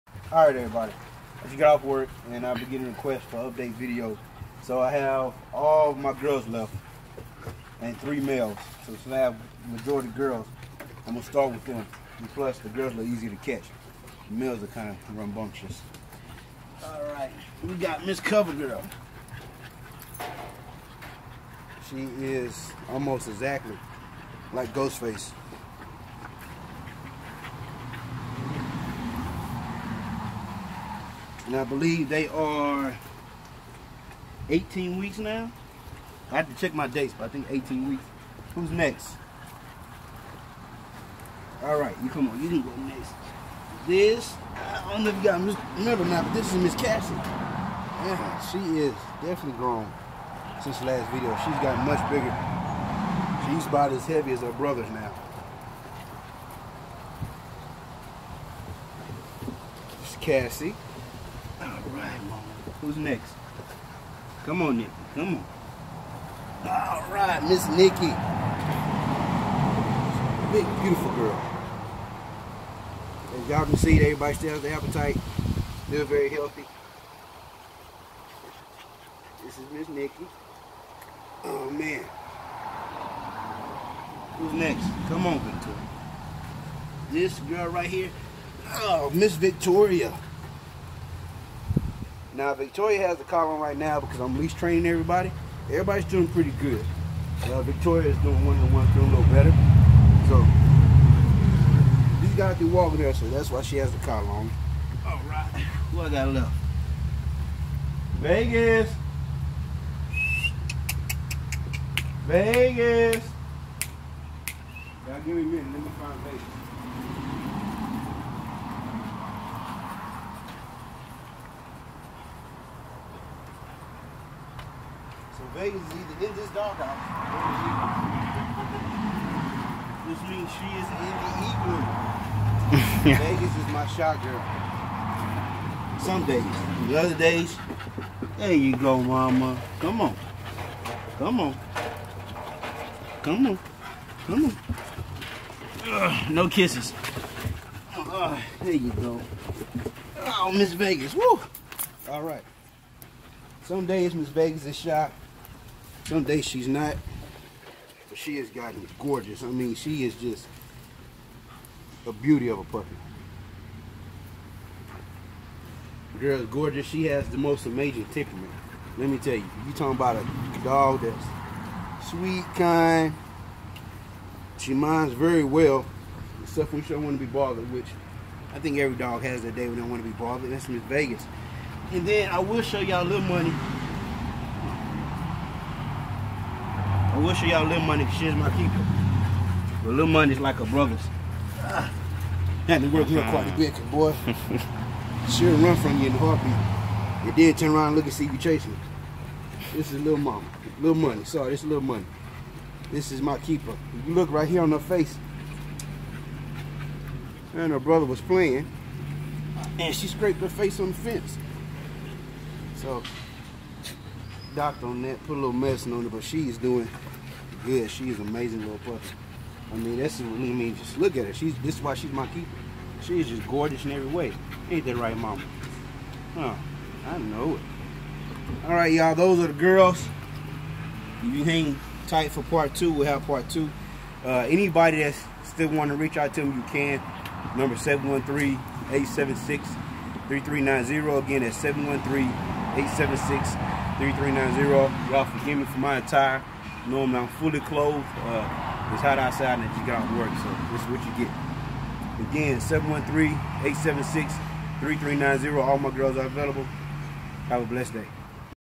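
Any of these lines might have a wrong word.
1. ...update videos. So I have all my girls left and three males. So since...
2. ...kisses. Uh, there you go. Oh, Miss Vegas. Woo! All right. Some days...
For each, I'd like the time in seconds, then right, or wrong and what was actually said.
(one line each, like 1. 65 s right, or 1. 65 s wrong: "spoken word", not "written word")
1. 3 s right
2. 146 s right.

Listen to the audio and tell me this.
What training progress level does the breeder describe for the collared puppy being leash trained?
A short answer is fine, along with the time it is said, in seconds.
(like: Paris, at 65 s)
one to one, at 98 s.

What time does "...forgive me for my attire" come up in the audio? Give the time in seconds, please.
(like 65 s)
245 s.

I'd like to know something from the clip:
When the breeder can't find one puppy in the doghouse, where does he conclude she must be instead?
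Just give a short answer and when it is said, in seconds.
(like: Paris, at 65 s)
the igloo, at 131 s.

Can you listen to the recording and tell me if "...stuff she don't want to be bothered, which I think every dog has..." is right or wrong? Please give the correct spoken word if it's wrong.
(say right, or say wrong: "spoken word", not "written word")
right.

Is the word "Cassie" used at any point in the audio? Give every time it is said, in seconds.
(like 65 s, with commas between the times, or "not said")
46 s, 60 s.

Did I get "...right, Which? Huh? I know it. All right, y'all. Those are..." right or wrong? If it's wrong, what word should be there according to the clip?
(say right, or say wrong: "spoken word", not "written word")
wrong: "Mama", not "Which".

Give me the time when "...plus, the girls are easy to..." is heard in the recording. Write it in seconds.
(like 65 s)
12 s.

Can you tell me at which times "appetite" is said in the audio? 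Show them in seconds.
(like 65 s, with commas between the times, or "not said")
74 s.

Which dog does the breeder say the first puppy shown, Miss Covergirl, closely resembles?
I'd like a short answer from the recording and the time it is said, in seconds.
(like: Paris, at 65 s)
Ghostface, at 24 s.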